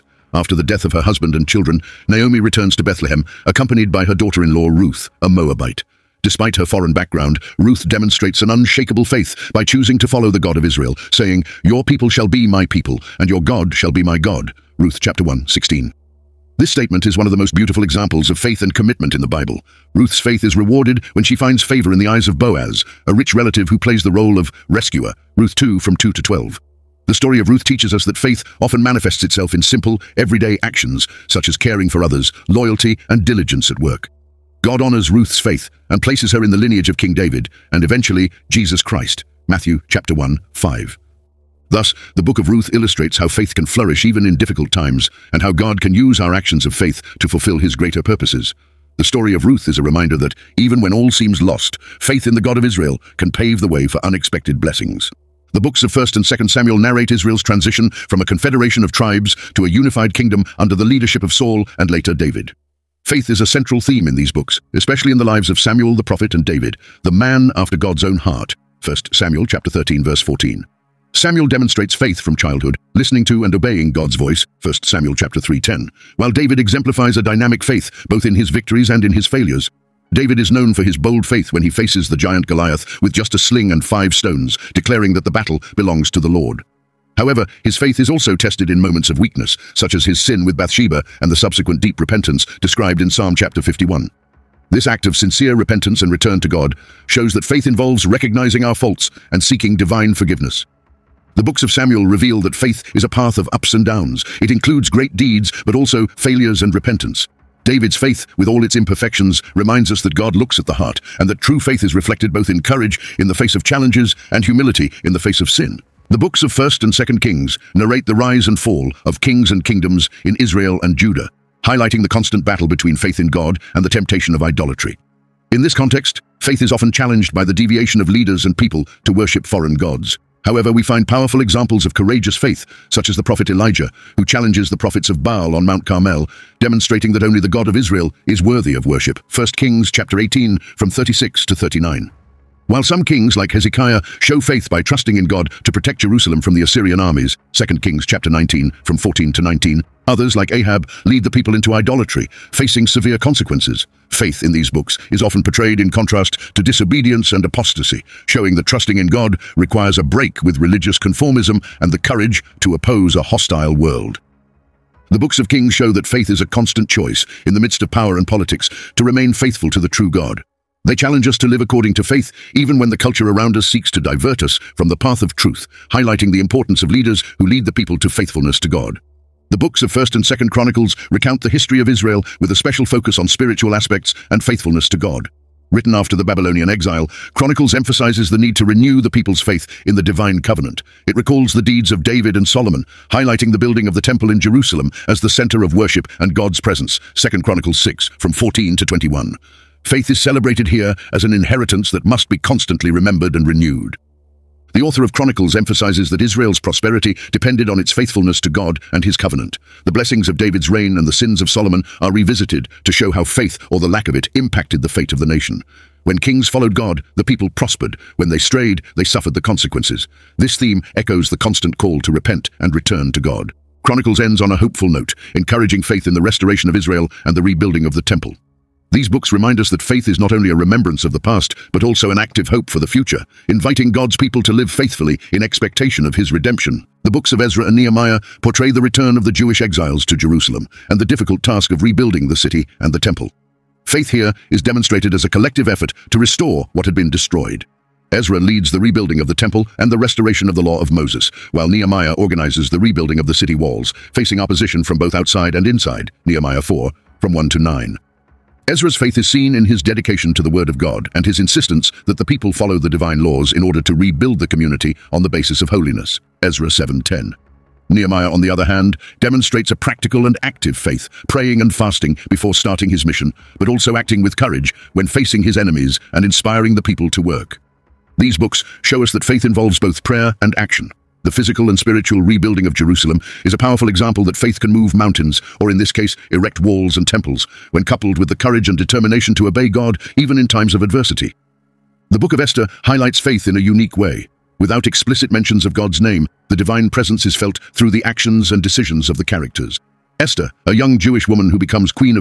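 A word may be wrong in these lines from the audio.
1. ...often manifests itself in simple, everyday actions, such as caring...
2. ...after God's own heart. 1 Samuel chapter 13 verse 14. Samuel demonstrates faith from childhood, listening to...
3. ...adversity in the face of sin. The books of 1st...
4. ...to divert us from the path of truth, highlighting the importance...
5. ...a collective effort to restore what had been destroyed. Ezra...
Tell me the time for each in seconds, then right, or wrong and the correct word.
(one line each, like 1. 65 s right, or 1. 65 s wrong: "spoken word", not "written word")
1. 28 s right
2. 67 s right
3. 114 s wrong: "humility", not "adversity"
4. 173 s right
5. 245 s right.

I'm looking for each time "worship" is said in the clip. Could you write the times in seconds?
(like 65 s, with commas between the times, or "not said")
129 s, 138 s, 195 s.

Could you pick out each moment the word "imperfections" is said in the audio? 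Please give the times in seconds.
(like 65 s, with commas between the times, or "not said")
108 s.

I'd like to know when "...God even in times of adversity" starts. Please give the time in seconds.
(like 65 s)
289 s.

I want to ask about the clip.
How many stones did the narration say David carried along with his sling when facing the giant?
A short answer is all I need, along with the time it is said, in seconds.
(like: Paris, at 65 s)
5, at 83 s.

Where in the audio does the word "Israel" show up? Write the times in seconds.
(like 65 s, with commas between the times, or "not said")
10 s, 52 s, 57 s, 120 s, 137 s, 181 s, 206 s, 226 s.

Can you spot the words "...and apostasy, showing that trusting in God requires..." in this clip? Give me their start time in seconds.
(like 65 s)
157 s.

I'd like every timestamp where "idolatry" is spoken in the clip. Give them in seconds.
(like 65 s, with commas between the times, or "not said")
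124 s, 151 s.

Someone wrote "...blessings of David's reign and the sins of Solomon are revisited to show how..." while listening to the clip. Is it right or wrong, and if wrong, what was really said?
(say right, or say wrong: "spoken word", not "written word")
right.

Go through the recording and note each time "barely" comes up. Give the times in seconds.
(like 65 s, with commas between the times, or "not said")
not said.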